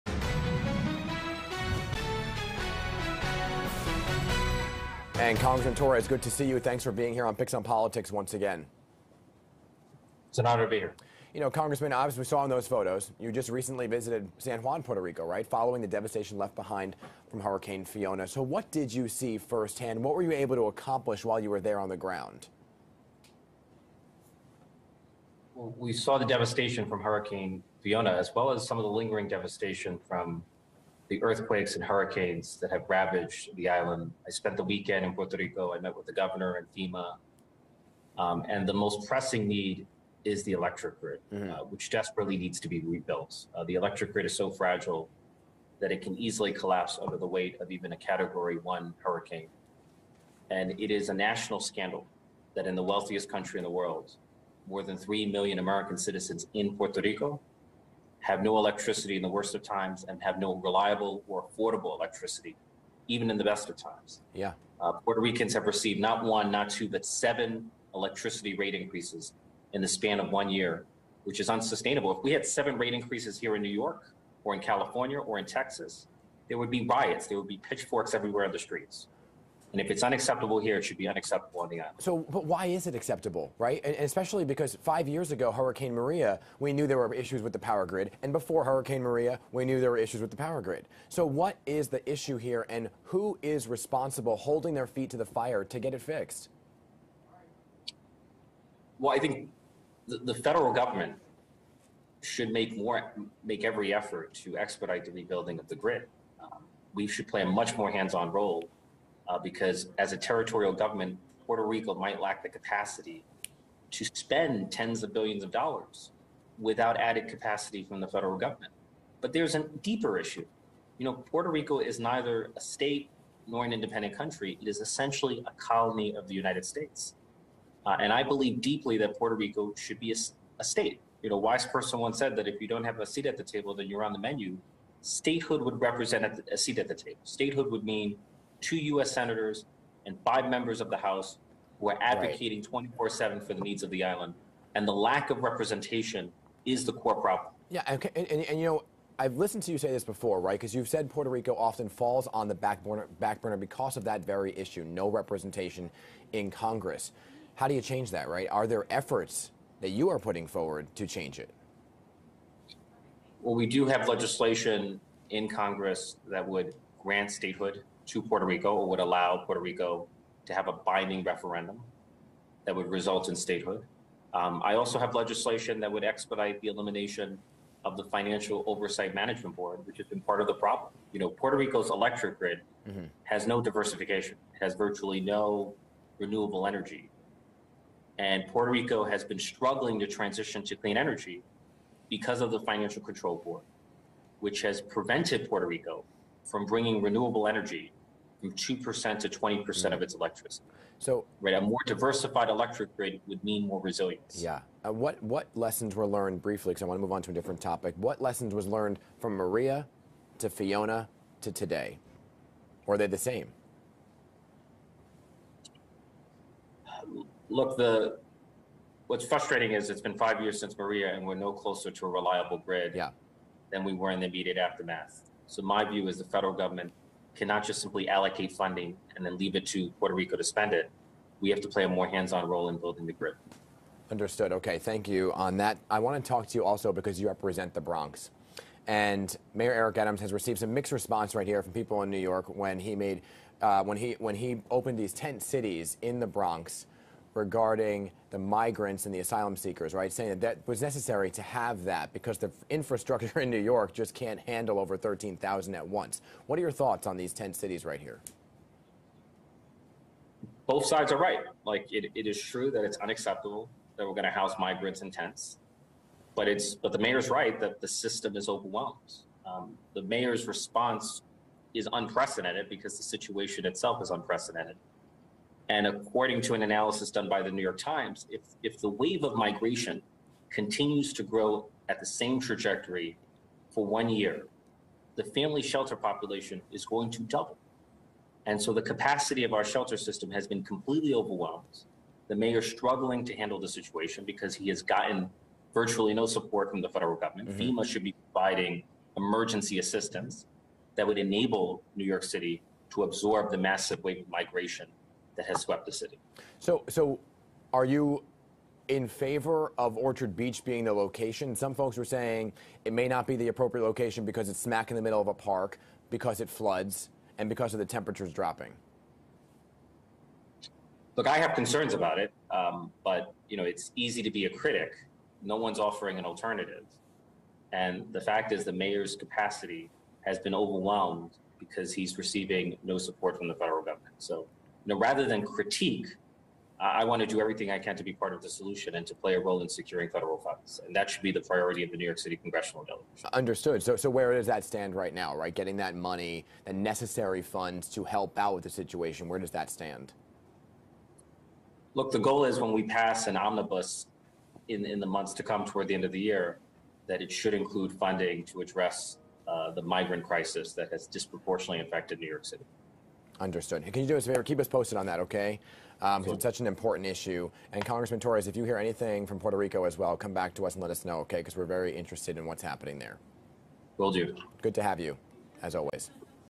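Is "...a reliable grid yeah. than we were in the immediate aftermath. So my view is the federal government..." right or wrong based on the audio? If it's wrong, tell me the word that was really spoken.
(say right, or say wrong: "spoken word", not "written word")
right.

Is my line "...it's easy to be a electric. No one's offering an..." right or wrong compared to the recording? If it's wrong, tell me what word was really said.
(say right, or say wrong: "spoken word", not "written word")
wrong: "critic", not "electric".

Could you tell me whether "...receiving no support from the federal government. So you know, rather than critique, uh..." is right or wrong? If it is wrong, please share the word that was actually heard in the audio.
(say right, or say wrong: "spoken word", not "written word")
right.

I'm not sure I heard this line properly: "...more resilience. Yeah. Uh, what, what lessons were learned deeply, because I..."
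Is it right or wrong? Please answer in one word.
wrong.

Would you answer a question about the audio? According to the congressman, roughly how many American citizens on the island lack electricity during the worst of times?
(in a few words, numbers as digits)
more than 3 million.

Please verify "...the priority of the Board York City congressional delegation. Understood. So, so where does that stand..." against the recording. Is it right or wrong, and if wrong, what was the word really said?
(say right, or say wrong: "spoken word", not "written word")
wrong: "New", not "Board".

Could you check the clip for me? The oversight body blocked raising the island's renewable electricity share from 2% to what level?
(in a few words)
20%.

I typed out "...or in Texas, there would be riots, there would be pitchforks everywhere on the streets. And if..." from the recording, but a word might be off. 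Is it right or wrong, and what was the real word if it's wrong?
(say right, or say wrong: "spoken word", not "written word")
right.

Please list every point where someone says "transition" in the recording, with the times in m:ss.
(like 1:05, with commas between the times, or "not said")
3:10.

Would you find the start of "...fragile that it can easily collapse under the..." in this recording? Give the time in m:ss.
0:44.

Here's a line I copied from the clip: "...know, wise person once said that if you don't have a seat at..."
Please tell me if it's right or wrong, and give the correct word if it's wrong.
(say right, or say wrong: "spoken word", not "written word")
right.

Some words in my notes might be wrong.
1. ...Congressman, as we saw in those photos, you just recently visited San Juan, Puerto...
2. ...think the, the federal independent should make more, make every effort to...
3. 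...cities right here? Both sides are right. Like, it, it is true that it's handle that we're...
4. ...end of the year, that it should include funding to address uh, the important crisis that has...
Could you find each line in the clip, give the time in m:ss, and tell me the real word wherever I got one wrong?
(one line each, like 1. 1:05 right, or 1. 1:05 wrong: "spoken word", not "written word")
1. 0:11 right
2. 1:39 wrong: "government", not "independent"
3. 4:17 wrong: "unacceptable", not "handle"
4. 5:55 wrong: "migrant", not "important".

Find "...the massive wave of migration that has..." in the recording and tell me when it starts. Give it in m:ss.
5:03.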